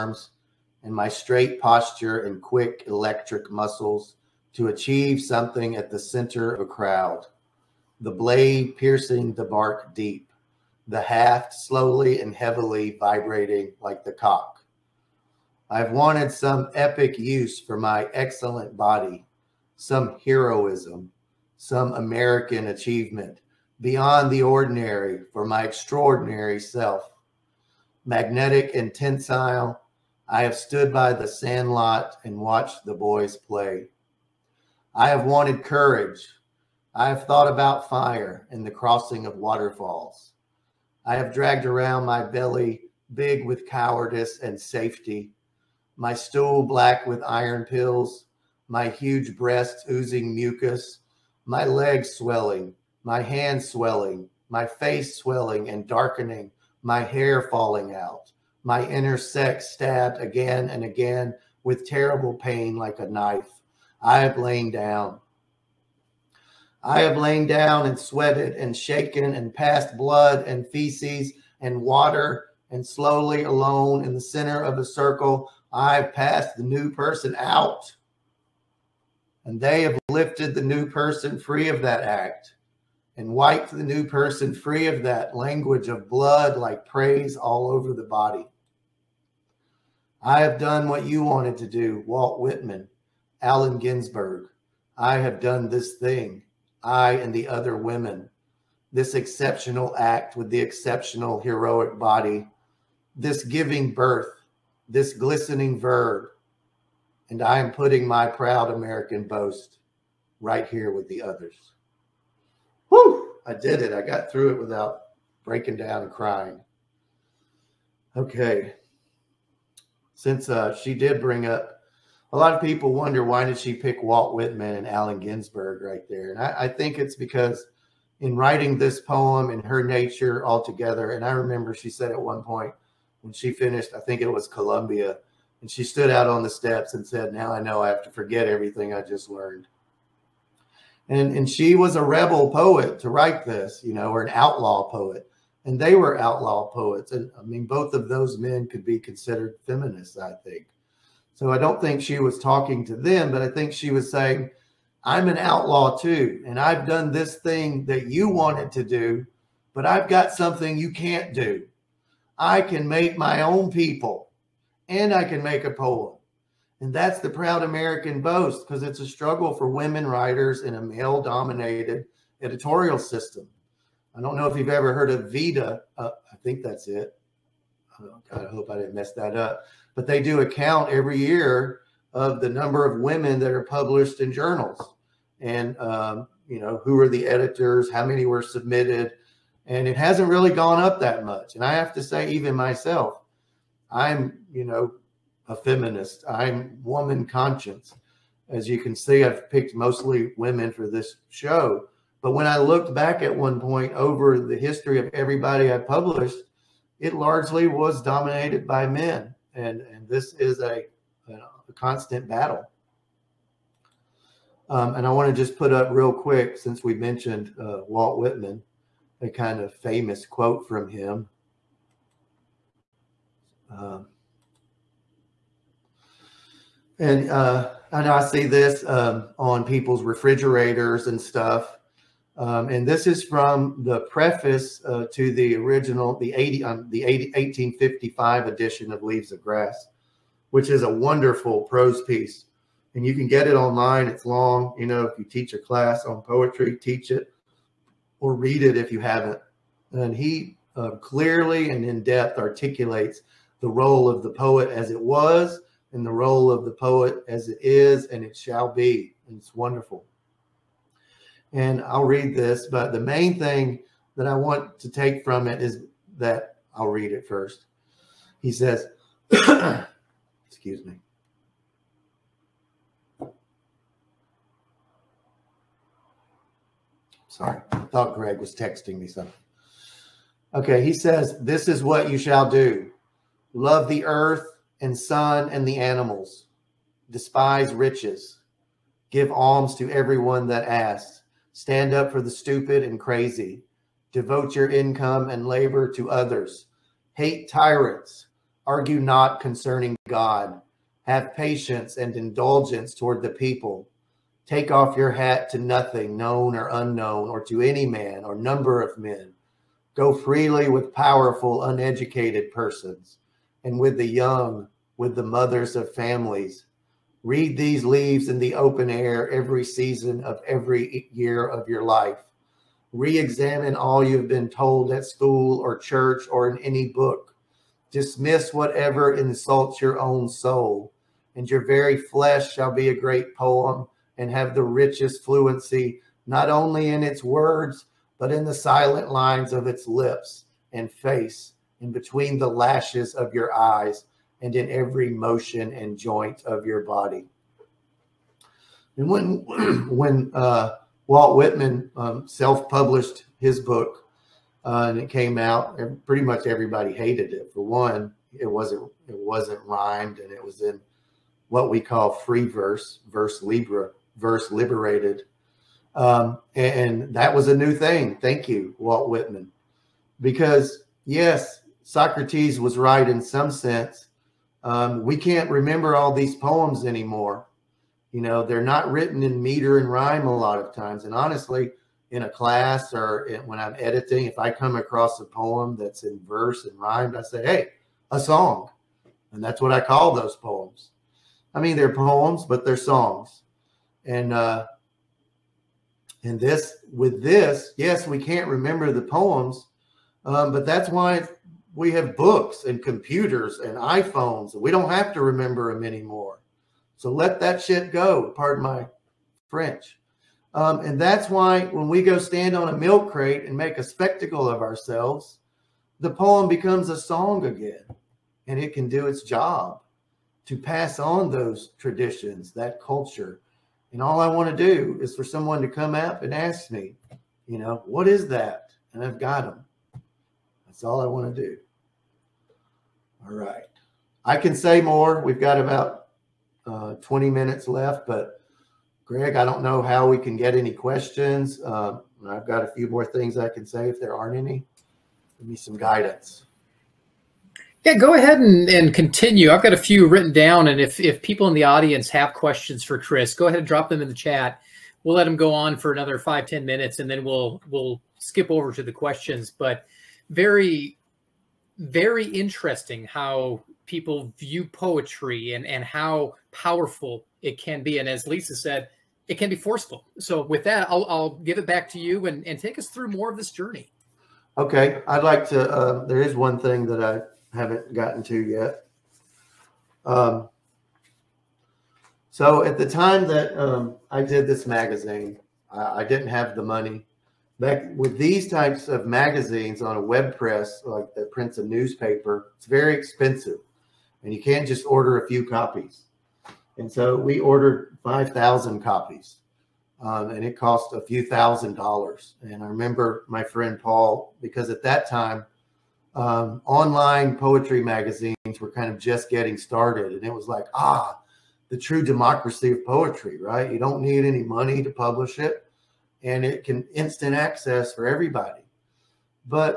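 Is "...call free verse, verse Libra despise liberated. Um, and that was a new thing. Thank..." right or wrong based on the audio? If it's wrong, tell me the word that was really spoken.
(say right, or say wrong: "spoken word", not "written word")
wrong: "verse", not "despise".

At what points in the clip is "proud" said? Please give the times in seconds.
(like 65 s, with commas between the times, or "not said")
108 s, 167 s.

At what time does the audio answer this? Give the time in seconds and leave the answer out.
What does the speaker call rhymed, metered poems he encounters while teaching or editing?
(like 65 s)
392 s.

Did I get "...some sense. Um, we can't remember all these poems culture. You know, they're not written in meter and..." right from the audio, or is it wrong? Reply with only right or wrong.
wrong.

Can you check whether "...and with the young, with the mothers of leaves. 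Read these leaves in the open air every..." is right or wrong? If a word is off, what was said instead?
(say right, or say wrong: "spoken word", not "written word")
wrong: "families", not "leaves".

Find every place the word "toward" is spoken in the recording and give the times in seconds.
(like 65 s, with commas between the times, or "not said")
302 s.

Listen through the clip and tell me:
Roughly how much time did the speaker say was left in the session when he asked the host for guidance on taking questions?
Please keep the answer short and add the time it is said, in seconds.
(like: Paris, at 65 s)
20 minutes, at 436 s.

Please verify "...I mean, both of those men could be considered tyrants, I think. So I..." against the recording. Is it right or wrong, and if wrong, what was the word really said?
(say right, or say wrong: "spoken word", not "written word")
wrong: "feminists", not "tyrants".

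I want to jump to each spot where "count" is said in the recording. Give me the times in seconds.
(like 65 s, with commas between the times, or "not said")
180 s.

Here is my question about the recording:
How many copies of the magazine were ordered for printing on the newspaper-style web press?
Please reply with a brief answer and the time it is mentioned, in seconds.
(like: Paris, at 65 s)
5000, at 498 s.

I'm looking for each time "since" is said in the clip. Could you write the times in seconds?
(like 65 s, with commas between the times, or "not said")
120 s, 216 s.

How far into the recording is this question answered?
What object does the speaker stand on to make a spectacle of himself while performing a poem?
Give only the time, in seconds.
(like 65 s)
412 s.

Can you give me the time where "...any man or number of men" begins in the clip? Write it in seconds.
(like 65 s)
307 s.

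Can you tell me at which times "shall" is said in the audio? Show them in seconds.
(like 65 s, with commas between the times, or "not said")
258 s, 282 s, 332 s.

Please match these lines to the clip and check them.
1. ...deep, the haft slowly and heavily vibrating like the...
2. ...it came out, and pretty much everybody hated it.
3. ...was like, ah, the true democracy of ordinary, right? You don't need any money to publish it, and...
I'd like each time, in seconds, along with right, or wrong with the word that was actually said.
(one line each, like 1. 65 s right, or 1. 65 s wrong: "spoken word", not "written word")
1. 9 s right
2. 354 s right
3. 510 s wrong: "poetry", not "ordinary".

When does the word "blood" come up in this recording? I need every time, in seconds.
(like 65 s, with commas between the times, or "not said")
69 s, 86 s.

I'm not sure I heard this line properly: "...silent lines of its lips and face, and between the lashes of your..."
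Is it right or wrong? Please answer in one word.
right.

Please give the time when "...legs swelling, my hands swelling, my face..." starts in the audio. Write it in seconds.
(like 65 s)
51 s.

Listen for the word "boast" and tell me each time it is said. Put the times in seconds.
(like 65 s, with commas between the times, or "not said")
109 s, 168 s.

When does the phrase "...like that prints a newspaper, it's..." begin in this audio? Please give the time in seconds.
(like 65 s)
490 s.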